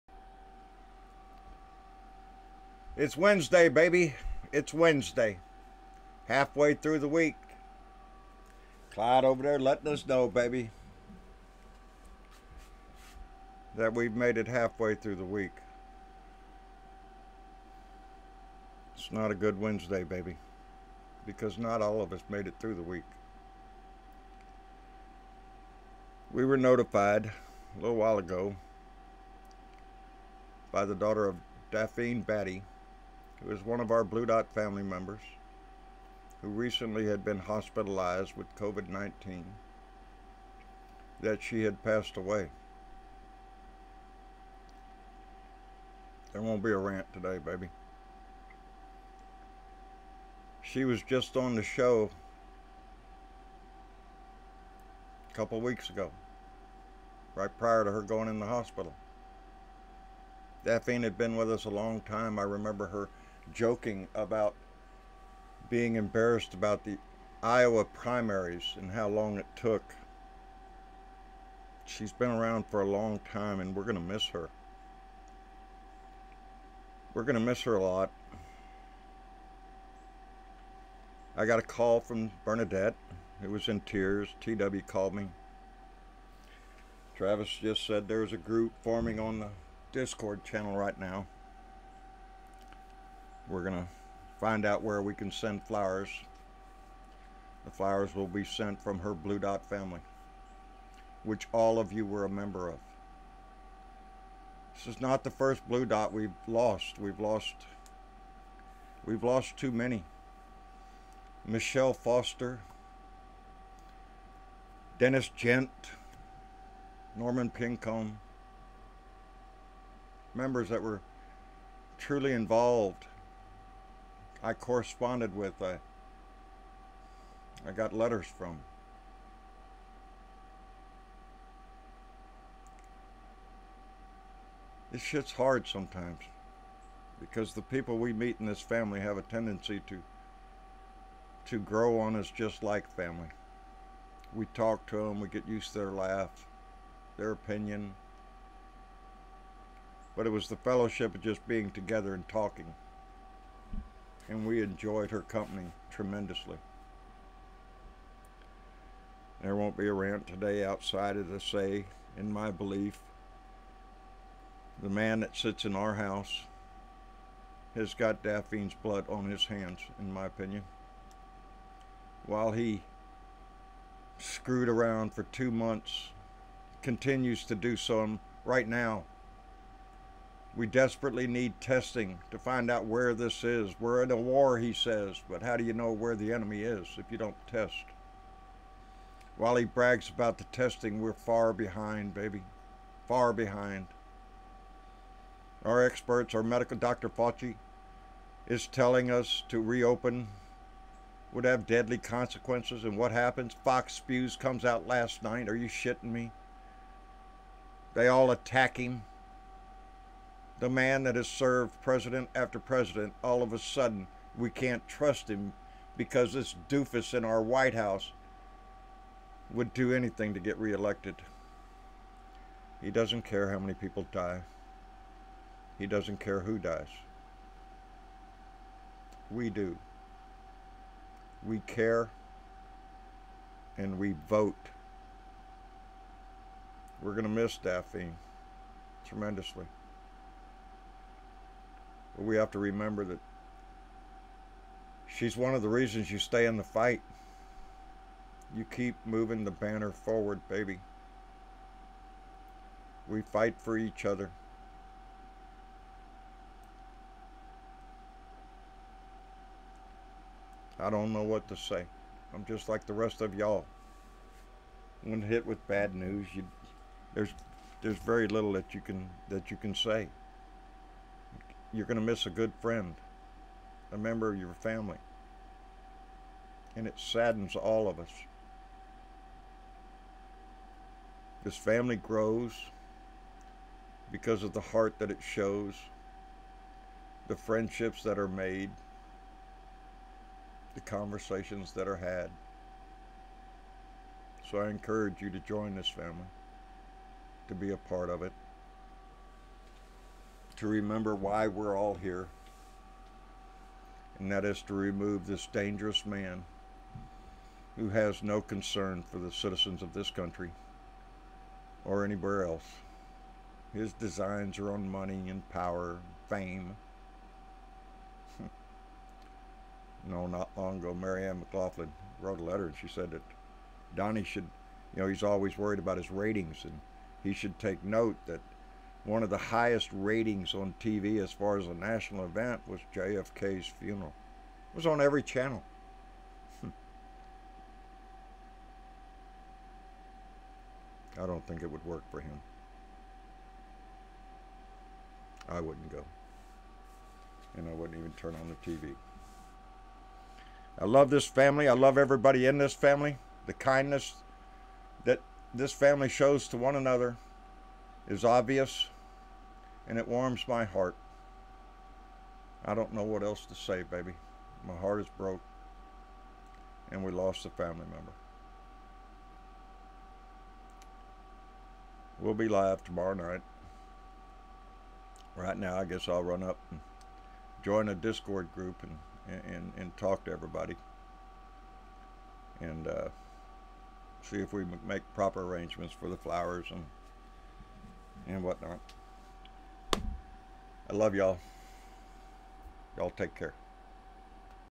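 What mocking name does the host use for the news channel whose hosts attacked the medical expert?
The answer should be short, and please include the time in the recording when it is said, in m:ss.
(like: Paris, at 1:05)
Fox Spews, at 3:23.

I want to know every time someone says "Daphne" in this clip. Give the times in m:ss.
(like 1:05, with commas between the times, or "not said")
0:31, 1:00, 2:48, 3:57.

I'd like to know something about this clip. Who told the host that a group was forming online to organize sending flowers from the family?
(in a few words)
Travis.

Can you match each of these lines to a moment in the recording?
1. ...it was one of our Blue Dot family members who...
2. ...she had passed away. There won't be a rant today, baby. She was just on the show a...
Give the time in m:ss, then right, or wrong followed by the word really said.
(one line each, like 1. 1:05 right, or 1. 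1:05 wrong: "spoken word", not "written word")
1. 0:33 right
2. 0:41 right.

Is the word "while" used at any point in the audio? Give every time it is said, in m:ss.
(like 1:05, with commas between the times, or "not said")
0:27, 2:52, 3:09.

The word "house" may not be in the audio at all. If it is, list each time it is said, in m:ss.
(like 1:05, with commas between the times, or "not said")
2:45, 3:37.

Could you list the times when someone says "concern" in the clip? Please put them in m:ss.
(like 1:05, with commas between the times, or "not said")
5:08.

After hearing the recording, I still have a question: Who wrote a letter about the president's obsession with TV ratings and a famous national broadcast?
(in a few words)
Mary Ann McLaughlin.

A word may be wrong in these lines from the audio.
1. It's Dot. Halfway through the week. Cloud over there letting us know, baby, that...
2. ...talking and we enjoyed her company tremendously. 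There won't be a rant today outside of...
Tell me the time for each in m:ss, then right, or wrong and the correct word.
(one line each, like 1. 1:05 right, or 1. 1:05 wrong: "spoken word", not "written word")
1. 0:04 wrong: "Wednesday", not "Dot"
2. 2:32 right.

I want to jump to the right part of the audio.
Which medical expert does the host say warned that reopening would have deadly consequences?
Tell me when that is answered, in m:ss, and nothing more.
3:16.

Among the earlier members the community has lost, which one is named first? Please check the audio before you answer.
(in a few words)
Michelle Foster.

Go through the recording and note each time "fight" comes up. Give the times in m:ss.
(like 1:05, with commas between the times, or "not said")
4:06, 4:13.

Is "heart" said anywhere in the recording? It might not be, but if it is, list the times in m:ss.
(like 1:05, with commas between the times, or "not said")
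4:44, 6:00, 6:04.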